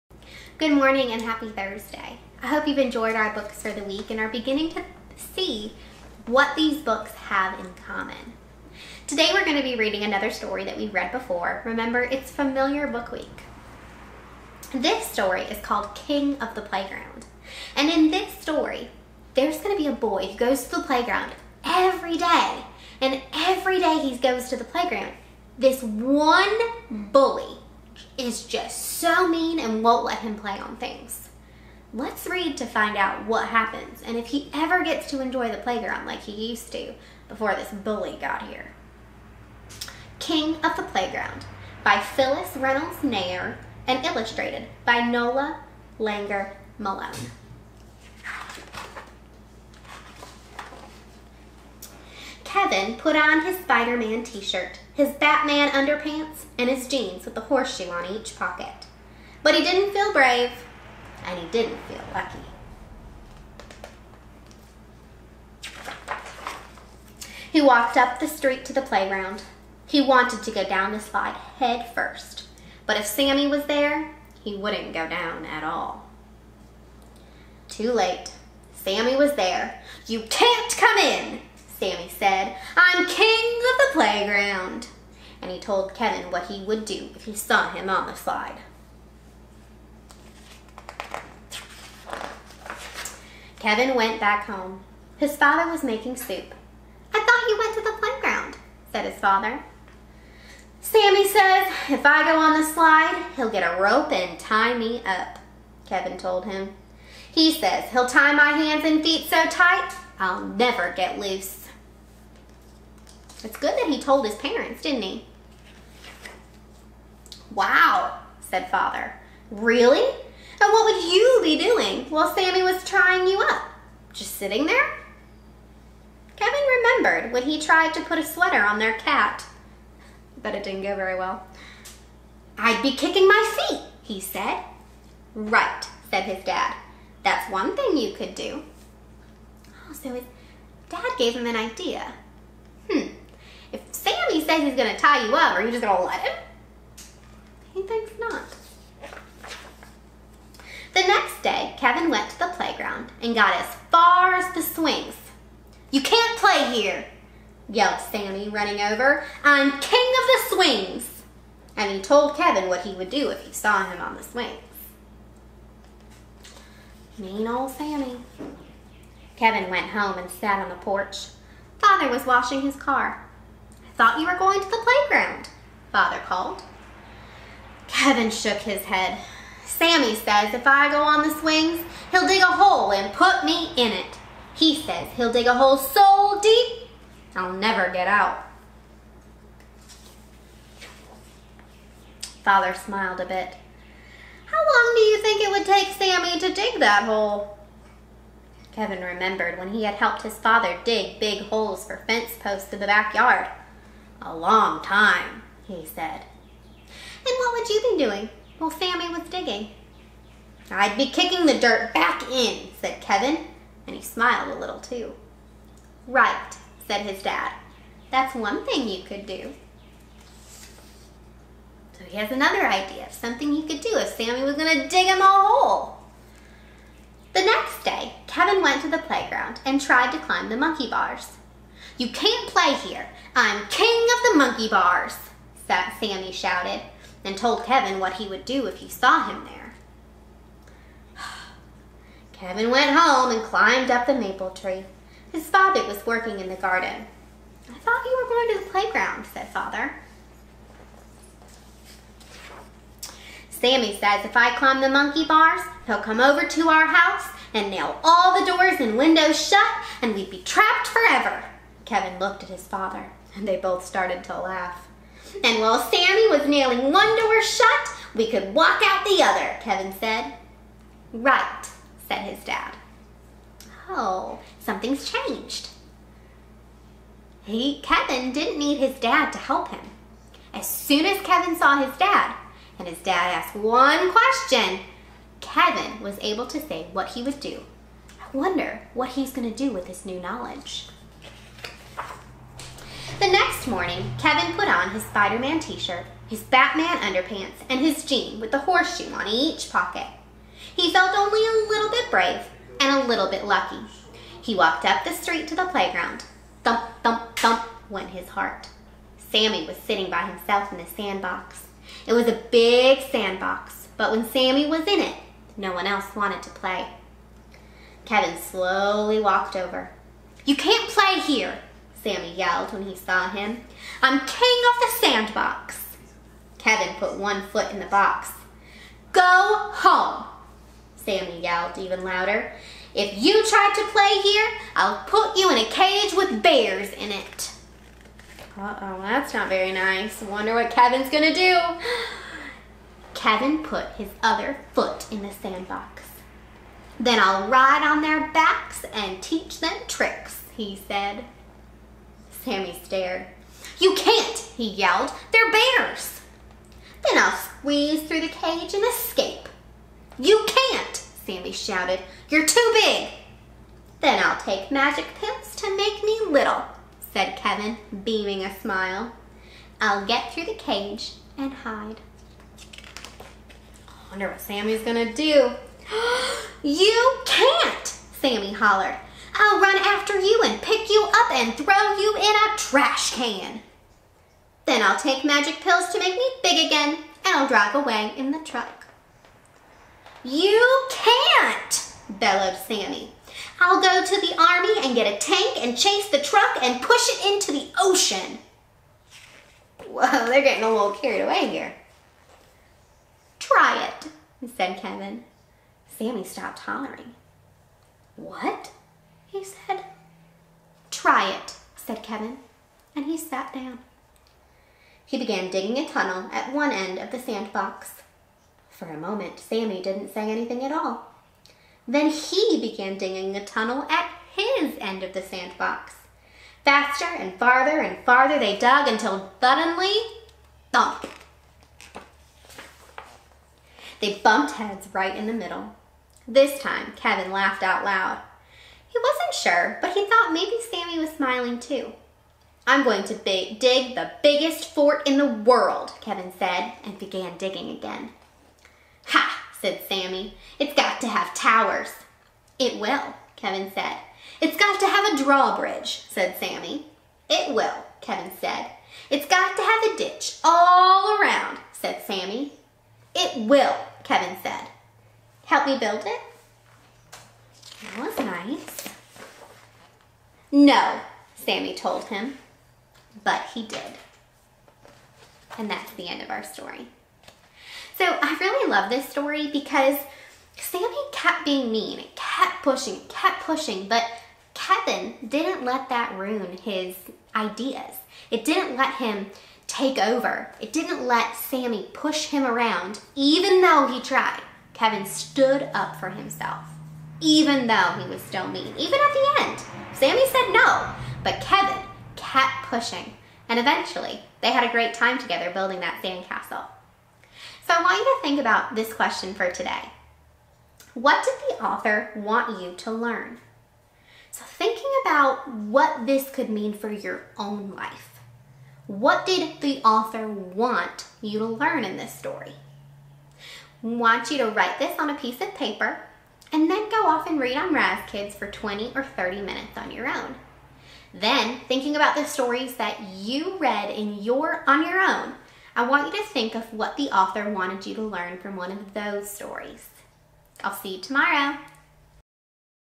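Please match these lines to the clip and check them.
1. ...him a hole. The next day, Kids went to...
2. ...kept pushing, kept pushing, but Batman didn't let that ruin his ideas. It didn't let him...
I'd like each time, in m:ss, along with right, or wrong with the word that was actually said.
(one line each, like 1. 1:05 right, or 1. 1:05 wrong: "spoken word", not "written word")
1. 3:45 wrong: "Kevin", not "Kids"
2. 8:02 wrong: "Kevin", not "Batman".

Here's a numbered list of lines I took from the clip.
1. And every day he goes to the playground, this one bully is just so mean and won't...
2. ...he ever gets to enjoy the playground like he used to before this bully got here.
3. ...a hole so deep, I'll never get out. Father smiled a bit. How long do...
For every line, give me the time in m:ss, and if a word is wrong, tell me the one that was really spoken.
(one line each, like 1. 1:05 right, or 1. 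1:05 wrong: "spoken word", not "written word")
1. 0:23 right
2. 0:34 right
3. 3:05 right.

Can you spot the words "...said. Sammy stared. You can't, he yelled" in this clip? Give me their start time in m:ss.
5:50.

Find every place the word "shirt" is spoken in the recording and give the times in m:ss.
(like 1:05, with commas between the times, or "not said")
0:54, 4:55.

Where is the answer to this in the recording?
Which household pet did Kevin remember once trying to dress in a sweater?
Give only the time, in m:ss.
2:08.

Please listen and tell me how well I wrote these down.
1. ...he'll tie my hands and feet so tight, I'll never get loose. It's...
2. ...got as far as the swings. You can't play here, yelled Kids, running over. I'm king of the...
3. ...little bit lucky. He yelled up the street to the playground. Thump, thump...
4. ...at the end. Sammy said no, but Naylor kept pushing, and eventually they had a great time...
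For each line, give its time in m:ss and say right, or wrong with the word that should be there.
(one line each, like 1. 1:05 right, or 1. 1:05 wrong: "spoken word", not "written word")
1. 1:47 right
2. 2:33 wrong: "Sammy", not "Kids"
3. 5:03 wrong: "walked", not "yelled"
4. 8:18 wrong: "Kevin", not "Naylor".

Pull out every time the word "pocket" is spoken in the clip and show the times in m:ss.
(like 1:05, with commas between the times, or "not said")
0:58, 4:59.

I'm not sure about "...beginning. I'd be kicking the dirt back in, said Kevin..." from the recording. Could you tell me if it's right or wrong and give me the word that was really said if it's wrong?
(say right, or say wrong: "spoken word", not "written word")
wrong: "digging", not "beginning".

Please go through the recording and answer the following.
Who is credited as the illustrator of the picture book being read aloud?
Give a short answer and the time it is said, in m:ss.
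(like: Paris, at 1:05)
Nola Langner Malone, at 0:45.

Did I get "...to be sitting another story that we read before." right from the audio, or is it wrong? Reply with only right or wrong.
wrong.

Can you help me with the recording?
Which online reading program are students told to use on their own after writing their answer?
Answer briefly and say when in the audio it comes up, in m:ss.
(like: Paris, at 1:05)
Raz Kids, at 8:47.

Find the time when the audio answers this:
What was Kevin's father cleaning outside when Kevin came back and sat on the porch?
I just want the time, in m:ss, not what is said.
2:52.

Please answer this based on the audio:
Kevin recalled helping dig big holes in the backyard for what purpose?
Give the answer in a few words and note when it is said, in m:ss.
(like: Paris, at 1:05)
Fence posts, at 3:22.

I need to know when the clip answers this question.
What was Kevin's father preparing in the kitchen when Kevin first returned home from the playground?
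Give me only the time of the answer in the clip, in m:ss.
1:35.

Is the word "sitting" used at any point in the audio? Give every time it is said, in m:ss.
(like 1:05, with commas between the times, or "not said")
2:04, 5:09.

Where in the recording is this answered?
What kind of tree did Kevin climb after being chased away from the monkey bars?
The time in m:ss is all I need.
4:04.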